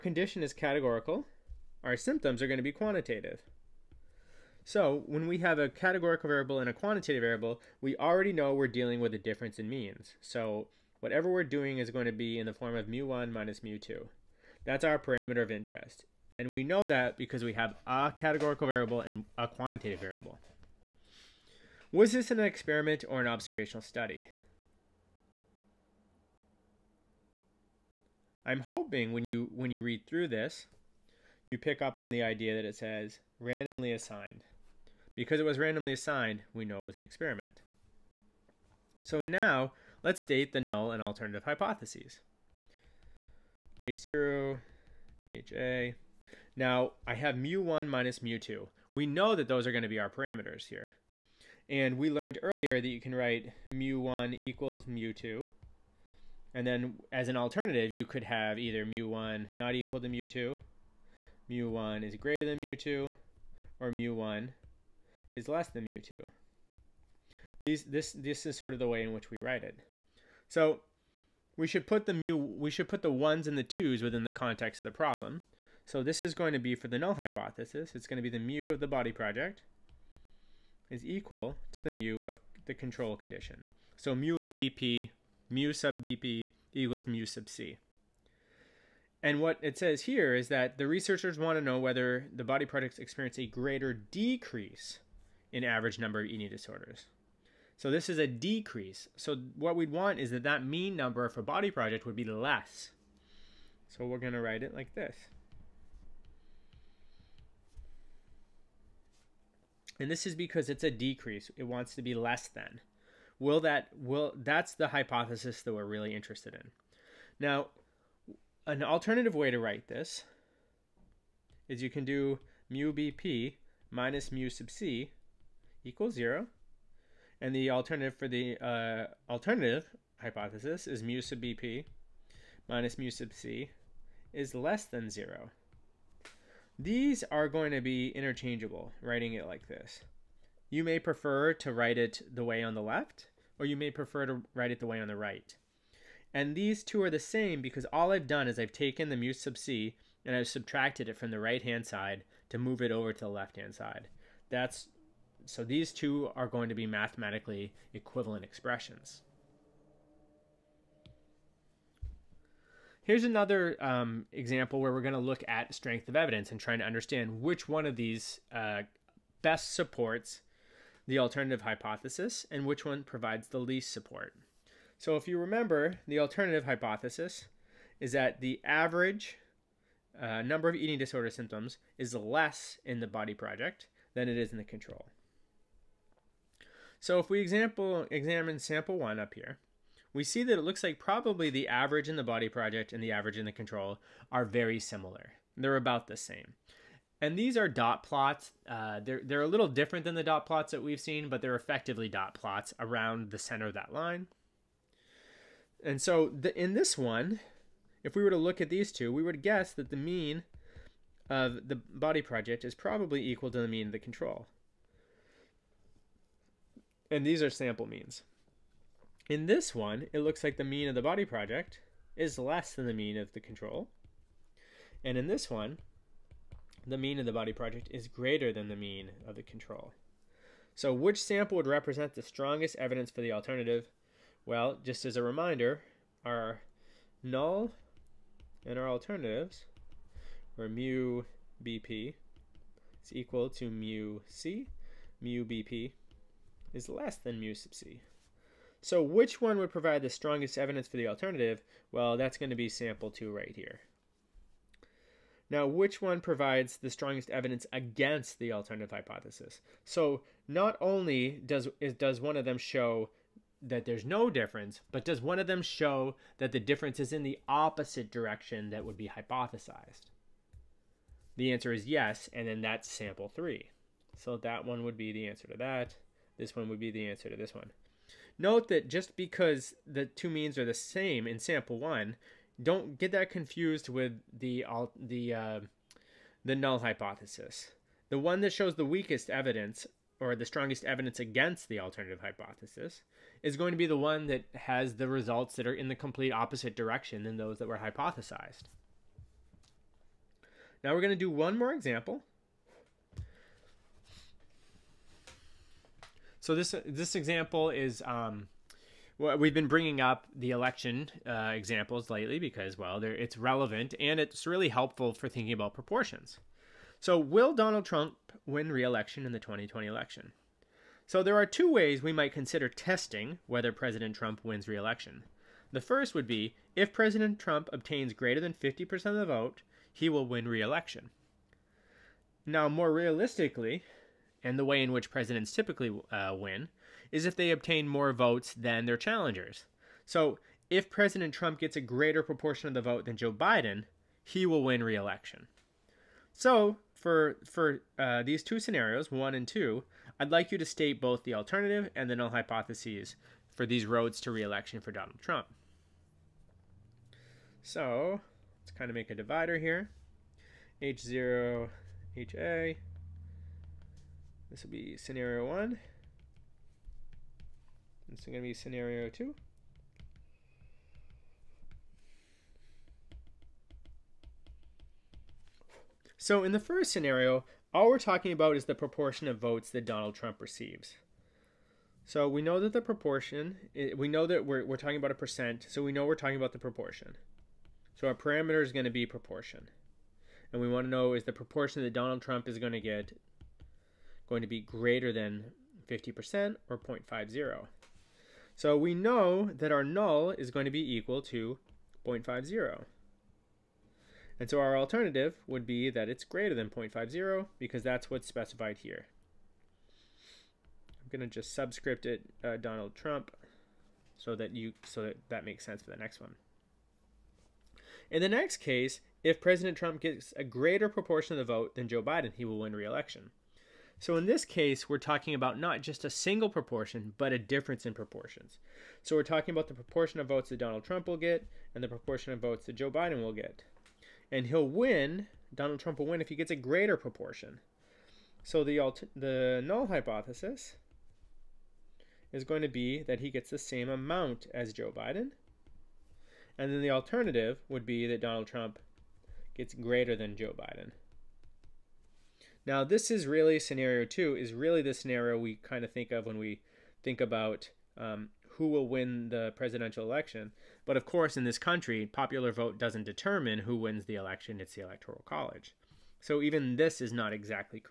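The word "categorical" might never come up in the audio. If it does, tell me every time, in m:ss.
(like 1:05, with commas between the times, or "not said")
0:00, 0:05, 0:18.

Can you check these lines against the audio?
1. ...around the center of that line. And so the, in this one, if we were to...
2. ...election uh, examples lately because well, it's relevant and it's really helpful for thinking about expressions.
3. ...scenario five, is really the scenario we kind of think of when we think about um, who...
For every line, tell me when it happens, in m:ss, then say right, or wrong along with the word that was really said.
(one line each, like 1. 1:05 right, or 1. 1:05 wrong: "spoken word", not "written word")
1. 3:22 right
2. 5:10 wrong: "proportions", not "expressions"
3. 7:33 wrong: "two", not "five".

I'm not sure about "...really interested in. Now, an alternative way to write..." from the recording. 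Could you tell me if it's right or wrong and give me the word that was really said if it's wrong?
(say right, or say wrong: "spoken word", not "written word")
right.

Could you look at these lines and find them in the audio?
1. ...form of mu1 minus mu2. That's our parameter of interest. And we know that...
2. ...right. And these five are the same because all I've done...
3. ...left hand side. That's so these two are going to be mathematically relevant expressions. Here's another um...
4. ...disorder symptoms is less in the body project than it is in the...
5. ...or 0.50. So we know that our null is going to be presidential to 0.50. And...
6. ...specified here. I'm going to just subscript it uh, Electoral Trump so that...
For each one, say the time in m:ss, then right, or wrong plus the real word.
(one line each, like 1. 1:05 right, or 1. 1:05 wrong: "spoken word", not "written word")
1. 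0:12 right
2. 2:25 wrong: "two", not "five"
3. 2:33 wrong: "equivalent", not "relevant"
4. 3:00 right
5. 6:36 wrong: "equal", not "presidential"
6. 6:48 wrong: "Donald", not "Electoral".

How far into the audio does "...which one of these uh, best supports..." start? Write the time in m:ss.
2:47.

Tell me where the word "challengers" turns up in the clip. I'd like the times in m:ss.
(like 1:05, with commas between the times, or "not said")
5:38.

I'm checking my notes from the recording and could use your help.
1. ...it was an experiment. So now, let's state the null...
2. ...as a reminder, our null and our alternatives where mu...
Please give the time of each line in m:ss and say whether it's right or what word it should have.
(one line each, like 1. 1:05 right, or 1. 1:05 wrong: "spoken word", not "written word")
1. 0:36 right
2. 3:55 right.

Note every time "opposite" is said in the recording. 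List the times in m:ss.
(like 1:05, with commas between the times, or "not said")
4:27, 4:56.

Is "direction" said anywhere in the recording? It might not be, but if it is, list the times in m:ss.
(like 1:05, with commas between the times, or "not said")
4:28, 4:56.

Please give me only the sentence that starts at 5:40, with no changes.
So, if President Trump gets a greater proportion of the vote than Joe Biden, he will win re election.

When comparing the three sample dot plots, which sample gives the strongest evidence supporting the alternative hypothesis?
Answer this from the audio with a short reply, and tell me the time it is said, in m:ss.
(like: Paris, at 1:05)
Sample 2, at 4:12.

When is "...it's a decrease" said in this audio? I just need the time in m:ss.
1:50.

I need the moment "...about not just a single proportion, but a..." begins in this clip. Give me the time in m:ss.
7:05.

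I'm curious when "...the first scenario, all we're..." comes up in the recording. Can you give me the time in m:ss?
6:16.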